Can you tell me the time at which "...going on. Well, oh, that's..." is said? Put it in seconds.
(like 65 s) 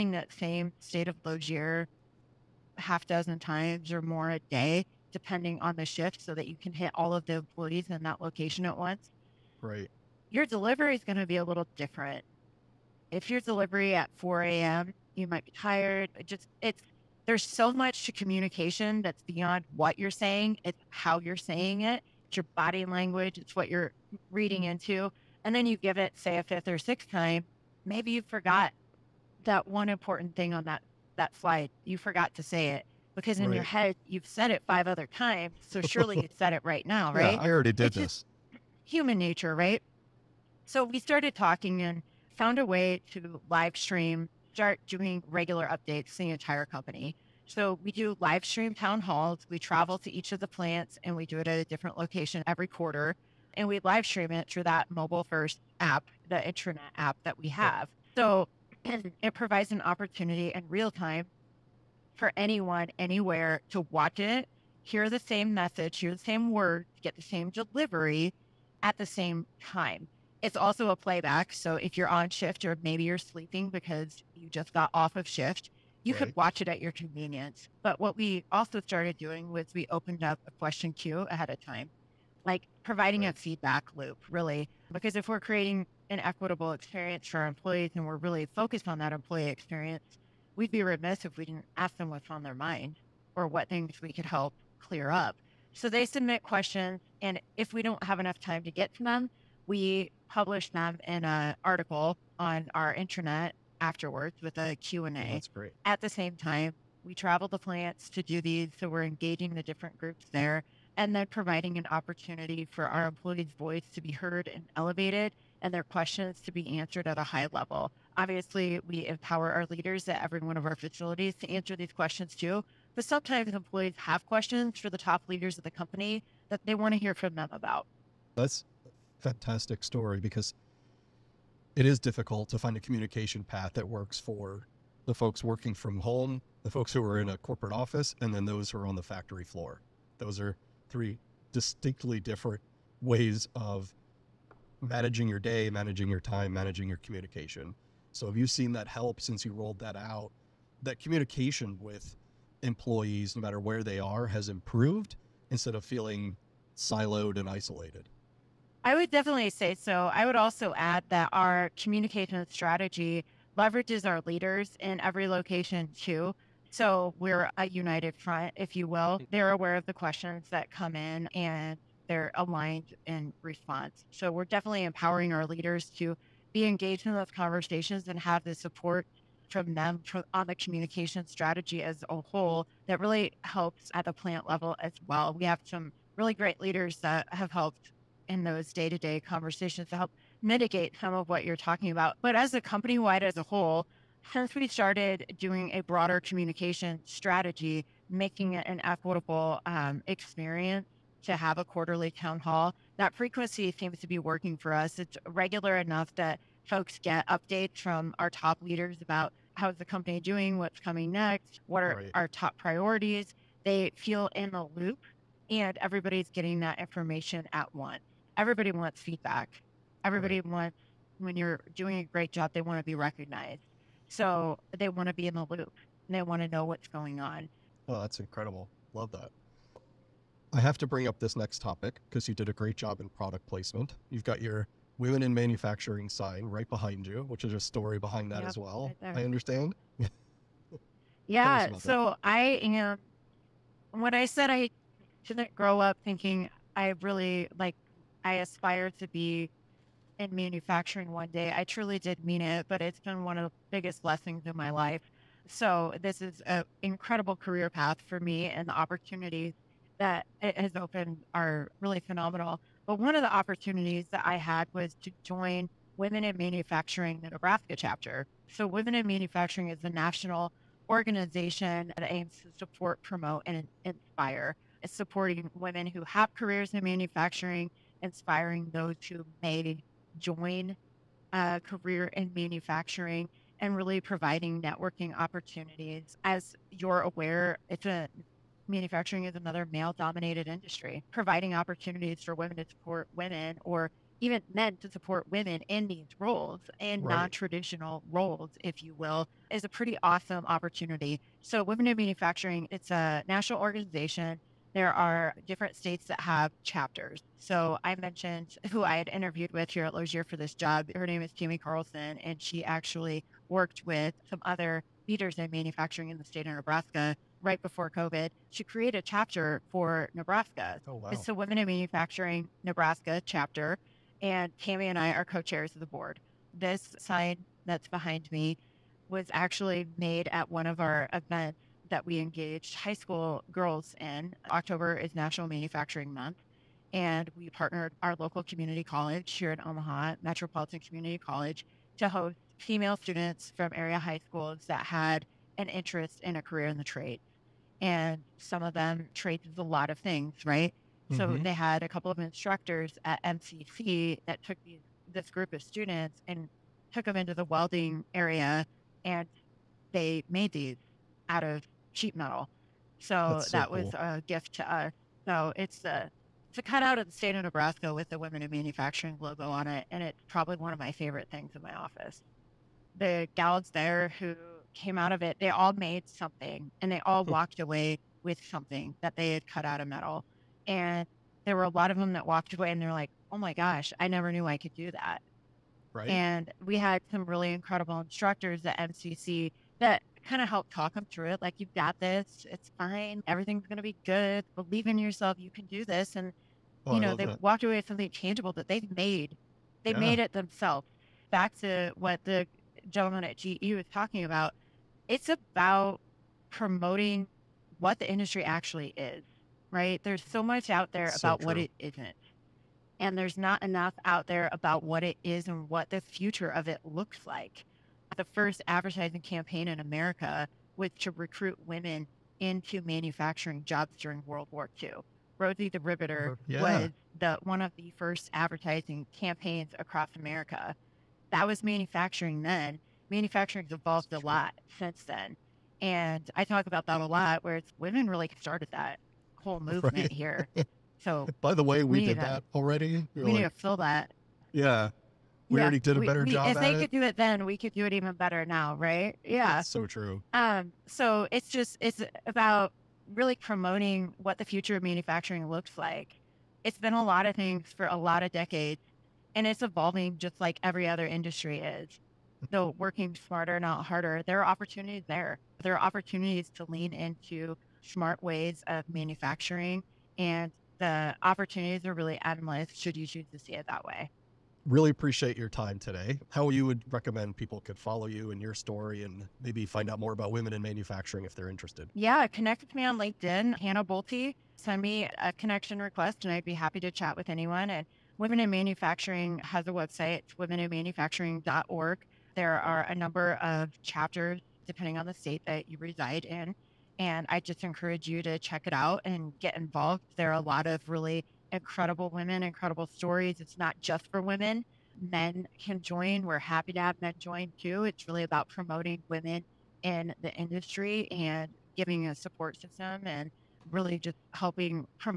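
226 s.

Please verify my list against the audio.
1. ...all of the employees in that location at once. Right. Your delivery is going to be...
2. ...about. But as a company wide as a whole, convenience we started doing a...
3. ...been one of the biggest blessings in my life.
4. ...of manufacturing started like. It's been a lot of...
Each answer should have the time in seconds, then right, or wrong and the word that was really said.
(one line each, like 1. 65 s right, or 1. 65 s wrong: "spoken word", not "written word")
1. 6 s right
2. 191 s wrong: "since", not "convenience"
3. 252 s right
4. 454 s wrong: "looked", not "started".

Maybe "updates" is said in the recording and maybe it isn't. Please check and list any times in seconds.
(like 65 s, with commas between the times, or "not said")
45 s, 207 s.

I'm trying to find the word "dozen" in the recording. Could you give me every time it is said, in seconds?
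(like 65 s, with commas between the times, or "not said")
3 s.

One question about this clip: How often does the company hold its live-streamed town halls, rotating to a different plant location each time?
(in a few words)
Every quarter.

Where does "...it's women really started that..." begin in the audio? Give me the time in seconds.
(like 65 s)
437 s.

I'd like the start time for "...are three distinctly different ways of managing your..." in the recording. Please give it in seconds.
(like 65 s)
140 s.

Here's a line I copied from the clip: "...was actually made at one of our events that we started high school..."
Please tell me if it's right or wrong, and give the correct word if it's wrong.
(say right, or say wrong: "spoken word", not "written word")
wrong: "engaged", not "started".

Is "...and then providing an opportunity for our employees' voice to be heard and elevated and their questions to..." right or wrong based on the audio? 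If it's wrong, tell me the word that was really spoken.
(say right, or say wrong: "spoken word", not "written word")
right.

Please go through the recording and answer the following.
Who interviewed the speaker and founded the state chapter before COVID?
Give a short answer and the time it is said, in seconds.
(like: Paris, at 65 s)
Kimmy Carlson, at 311 s.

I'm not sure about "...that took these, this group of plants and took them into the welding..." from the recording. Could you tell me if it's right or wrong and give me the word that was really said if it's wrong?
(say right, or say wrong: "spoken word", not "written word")
wrong: "students", not "plants".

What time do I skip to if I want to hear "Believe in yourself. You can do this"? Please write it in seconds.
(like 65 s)
394 s.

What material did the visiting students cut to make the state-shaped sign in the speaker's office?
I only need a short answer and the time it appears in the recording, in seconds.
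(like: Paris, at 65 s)
Sheet metal, at 361 s.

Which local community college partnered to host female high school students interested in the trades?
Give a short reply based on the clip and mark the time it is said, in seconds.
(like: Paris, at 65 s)
Metropolitan Community College, at 340 s.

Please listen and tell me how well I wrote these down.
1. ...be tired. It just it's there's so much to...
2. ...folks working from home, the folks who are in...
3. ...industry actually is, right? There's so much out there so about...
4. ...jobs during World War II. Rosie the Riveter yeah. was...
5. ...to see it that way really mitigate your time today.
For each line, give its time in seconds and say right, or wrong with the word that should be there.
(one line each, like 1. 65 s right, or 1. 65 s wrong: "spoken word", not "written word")
1. 15 s right
2. 135 s right
3. 408 s right
4. 423 s right
5. 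473 s wrong: "appreciate", not "mitigate".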